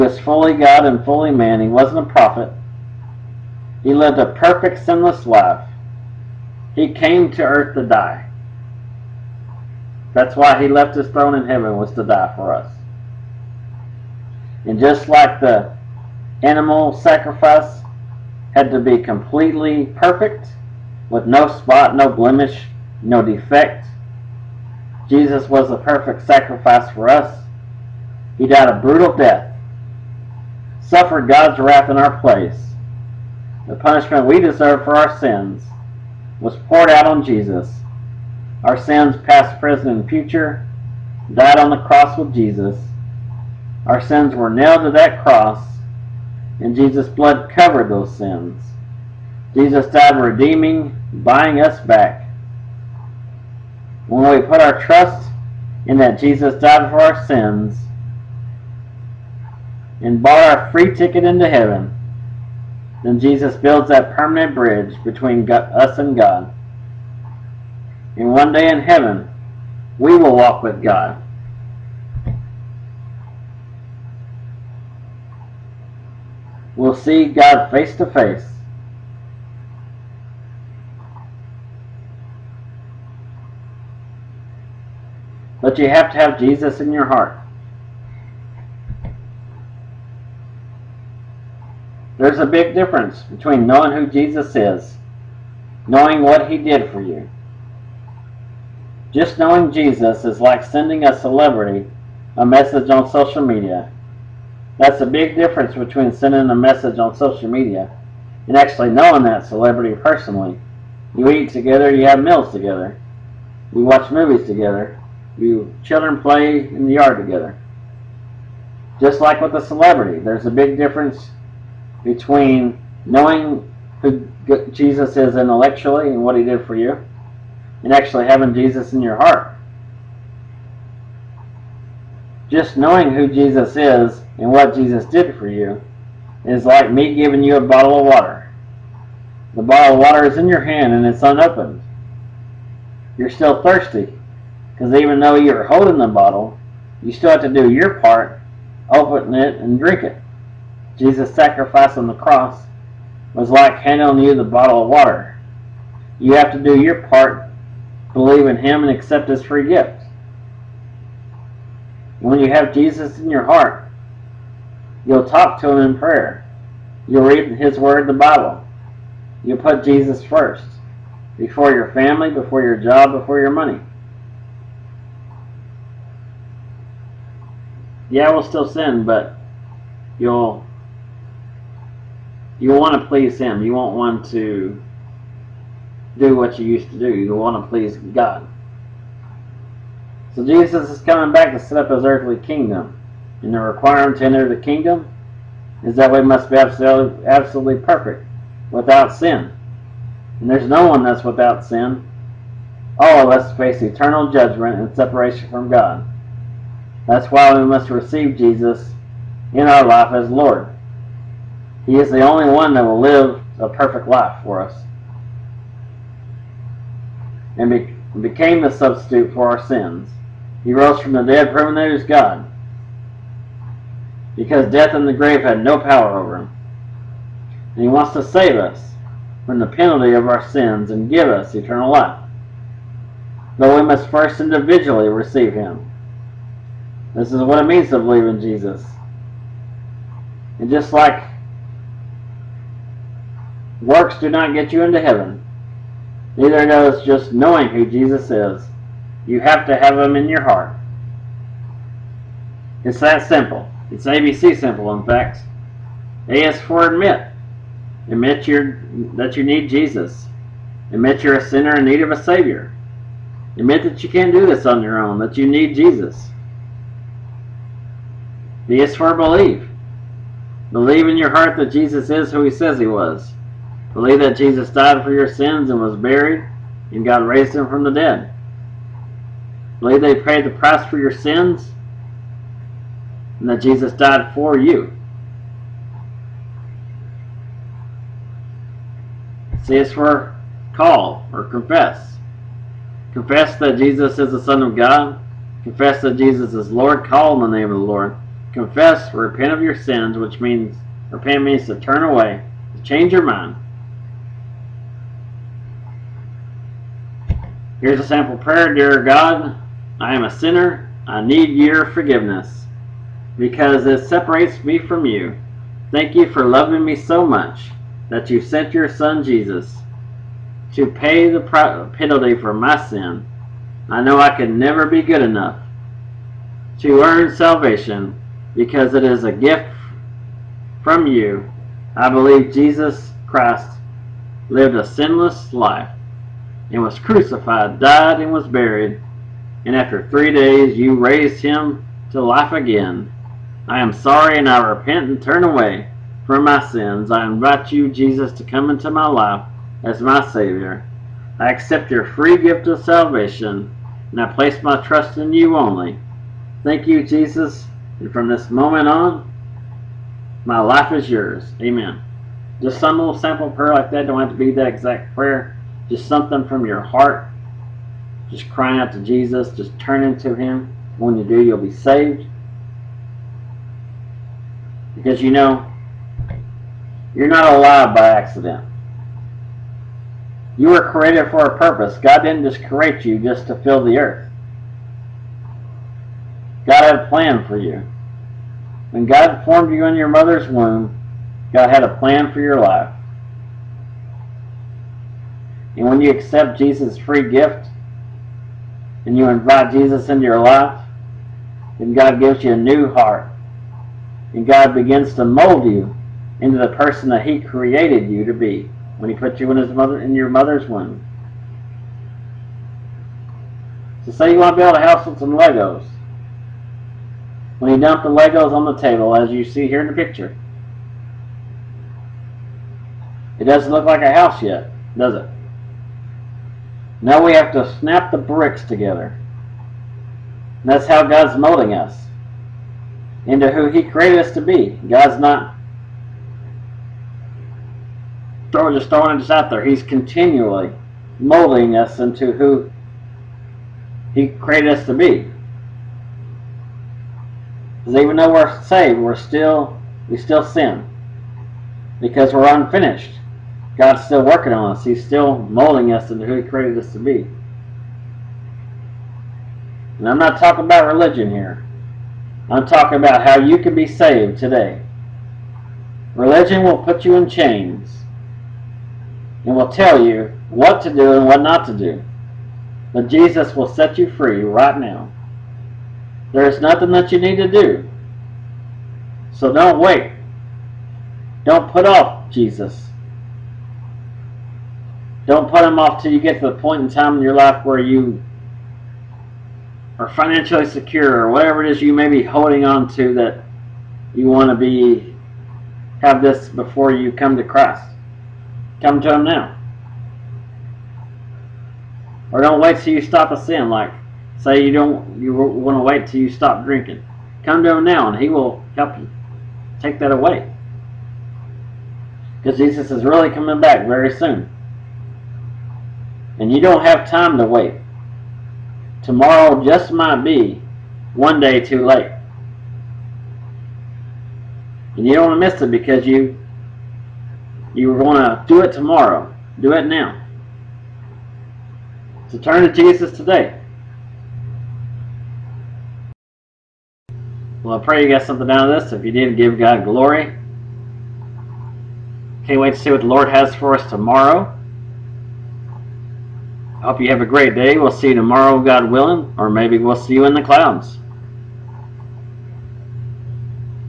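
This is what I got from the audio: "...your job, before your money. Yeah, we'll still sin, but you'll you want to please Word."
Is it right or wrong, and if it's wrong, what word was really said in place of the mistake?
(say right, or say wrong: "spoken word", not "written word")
wrong: "Him", not "Word".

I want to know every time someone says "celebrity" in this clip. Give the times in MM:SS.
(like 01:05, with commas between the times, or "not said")
01:41, 01:49, 01:59.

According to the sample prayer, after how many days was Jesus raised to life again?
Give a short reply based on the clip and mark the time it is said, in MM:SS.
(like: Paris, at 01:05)
3, at 05:40.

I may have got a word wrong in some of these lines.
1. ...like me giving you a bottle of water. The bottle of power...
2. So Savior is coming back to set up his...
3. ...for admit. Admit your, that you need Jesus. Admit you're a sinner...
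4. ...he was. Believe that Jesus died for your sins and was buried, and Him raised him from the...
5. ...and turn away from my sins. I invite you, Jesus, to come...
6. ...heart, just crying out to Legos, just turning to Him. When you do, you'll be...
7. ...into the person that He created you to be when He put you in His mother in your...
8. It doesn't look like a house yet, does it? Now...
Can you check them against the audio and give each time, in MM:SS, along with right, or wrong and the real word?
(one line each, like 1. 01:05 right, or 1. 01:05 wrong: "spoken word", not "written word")
1. 02:16 wrong: "water", not "power"
2. 03:10 wrong: "Jesus", not "Savior"
3. 04:16 right
4. 04:32 wrong: "God", not "Him"
5. 05:45 right
6. 06:06 wrong: "Jesus", not "Legos"
7. 06:46 right
8. 07:03 right.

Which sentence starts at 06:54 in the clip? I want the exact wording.
So say you want to build a house with some Legos.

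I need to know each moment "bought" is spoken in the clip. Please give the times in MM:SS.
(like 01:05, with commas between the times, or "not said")
01:00.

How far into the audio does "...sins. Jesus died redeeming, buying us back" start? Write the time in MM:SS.
00:48.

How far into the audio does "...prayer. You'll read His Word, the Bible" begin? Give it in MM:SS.
02:45.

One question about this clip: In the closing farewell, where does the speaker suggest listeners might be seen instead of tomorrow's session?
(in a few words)
in the clouds.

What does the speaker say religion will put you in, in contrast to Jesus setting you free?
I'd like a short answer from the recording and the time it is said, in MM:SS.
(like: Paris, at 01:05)
chains, at 07:47.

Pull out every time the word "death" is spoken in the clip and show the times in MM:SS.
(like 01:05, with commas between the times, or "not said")
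00:29, 03:44.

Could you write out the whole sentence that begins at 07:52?
But Jesus will set you free right now.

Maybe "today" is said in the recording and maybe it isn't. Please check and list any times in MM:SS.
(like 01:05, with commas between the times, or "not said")
07:44, 08:53.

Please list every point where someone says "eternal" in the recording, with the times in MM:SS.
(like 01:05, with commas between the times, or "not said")
03:23, 03:51.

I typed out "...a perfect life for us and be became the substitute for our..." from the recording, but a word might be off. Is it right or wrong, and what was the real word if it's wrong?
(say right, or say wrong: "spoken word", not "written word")
right.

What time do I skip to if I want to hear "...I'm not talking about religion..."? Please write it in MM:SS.
07:40.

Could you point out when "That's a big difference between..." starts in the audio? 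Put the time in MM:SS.
01:44.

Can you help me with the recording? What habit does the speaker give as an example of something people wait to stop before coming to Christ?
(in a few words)
drinking.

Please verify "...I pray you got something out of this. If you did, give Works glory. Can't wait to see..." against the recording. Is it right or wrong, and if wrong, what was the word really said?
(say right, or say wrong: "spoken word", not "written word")
wrong: "God", not "Works".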